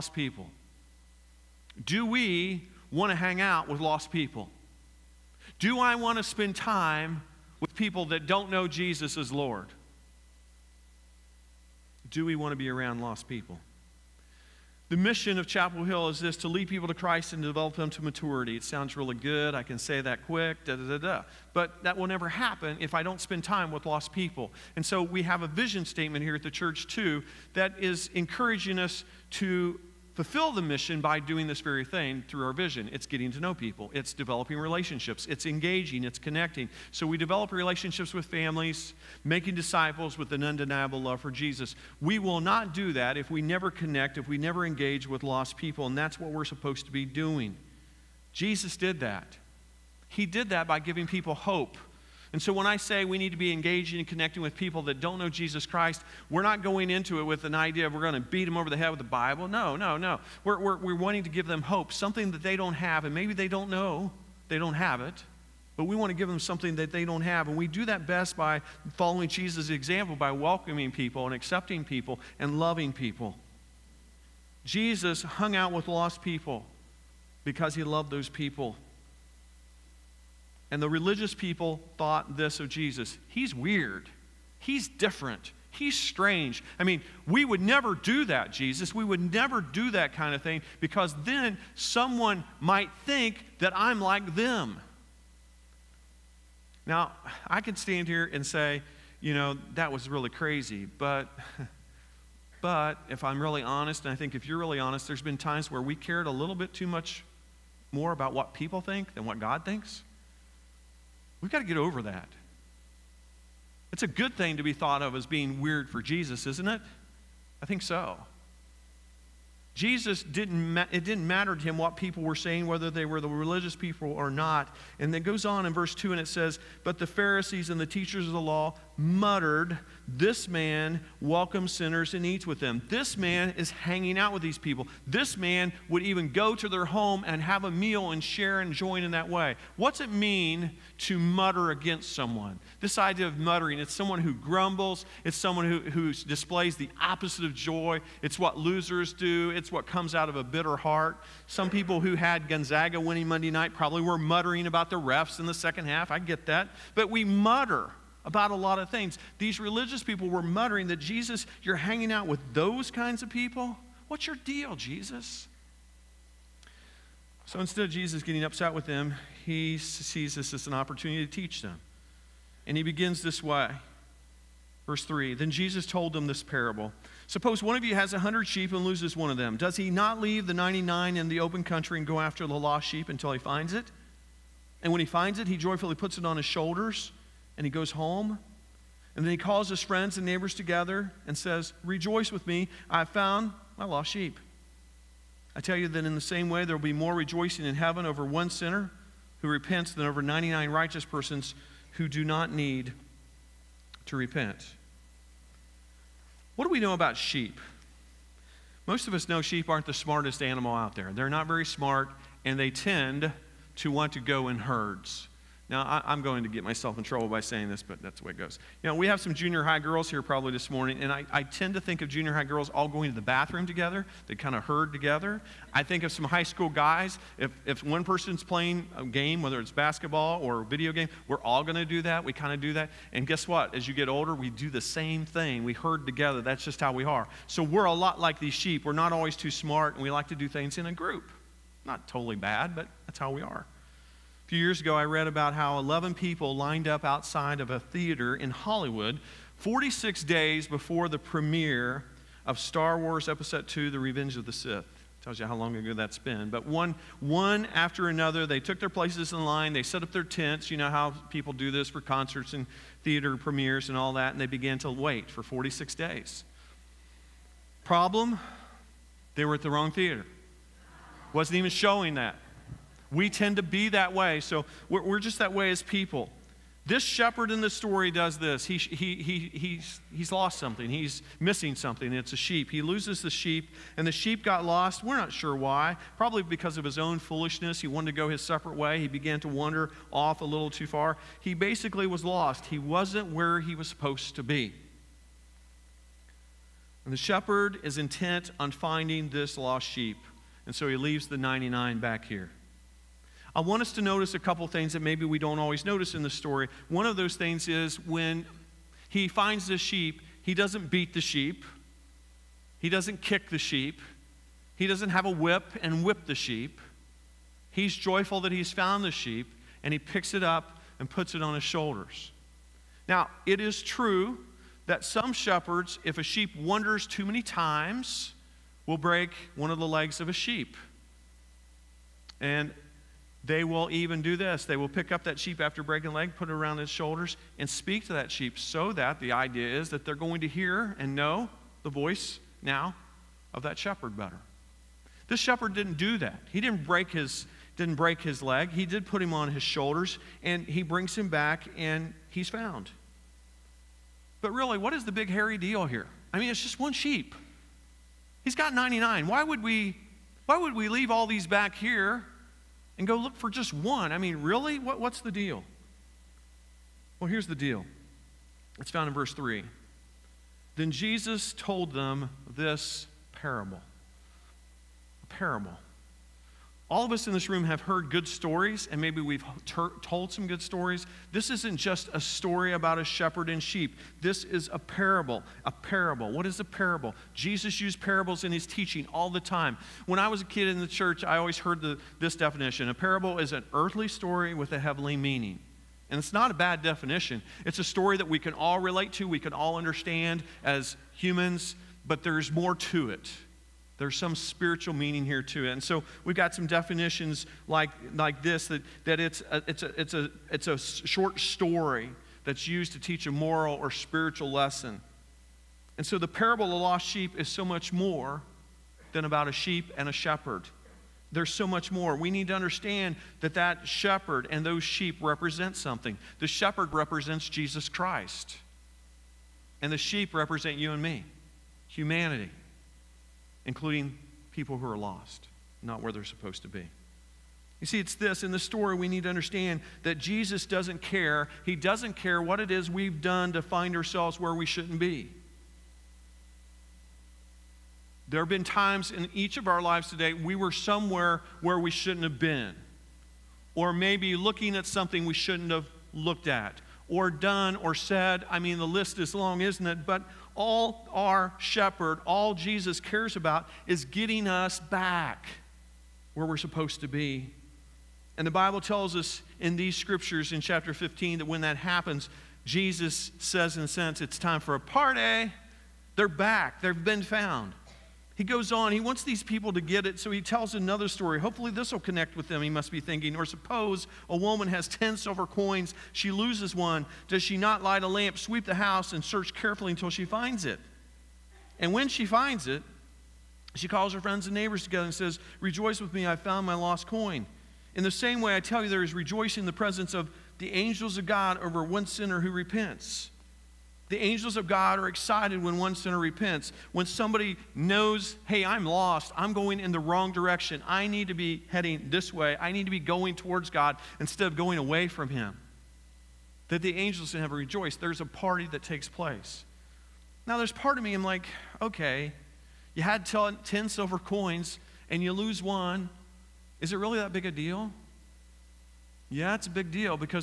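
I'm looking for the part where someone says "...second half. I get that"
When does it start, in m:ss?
2:35.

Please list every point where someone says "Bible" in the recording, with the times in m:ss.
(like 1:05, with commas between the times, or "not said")
0:59, 7:48.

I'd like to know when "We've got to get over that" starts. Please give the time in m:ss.
1:51.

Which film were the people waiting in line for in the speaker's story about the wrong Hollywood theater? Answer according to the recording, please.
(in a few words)
Star Wars Episode II.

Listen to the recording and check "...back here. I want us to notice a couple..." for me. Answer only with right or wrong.
right.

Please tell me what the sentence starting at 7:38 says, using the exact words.
I mean, the list is long, isn't it?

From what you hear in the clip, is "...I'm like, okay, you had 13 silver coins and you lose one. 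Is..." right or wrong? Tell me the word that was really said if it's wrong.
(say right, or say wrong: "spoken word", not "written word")
wrong: "10", not "13".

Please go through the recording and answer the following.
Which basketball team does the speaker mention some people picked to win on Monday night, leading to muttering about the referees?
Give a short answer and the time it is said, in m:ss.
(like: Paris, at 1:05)
Gonzaga, at 2:32.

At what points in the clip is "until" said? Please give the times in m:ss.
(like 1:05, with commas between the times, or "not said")
3:03, 8:09.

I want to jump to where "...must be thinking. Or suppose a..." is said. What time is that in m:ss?
8:02.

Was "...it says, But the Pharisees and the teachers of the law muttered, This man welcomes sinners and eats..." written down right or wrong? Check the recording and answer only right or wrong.
right.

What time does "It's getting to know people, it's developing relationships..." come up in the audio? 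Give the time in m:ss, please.
0:32.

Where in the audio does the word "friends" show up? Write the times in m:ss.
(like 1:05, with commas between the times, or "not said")
3:09, 8:14.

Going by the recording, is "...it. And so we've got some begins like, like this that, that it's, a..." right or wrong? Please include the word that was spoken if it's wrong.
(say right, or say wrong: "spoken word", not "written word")
wrong: "definitions", not "begins".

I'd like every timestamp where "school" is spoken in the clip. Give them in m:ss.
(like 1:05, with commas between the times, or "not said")
3:46.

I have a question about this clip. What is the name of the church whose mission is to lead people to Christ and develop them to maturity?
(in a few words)
Chapel Hill.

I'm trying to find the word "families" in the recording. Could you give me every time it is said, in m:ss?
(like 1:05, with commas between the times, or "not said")
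0:38.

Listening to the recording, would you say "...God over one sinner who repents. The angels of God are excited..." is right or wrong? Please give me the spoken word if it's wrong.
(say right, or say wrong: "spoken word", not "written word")
right.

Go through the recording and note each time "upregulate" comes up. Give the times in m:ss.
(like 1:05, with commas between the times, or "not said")
not said.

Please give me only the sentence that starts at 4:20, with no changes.
You know how people do this for concerts and theater premieres and all that, and they began to wait for 46 days.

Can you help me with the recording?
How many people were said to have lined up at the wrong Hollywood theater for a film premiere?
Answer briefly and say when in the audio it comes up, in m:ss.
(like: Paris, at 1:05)
11, at 4:05.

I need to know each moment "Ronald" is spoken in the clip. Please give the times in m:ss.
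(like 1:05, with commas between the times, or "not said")
not said.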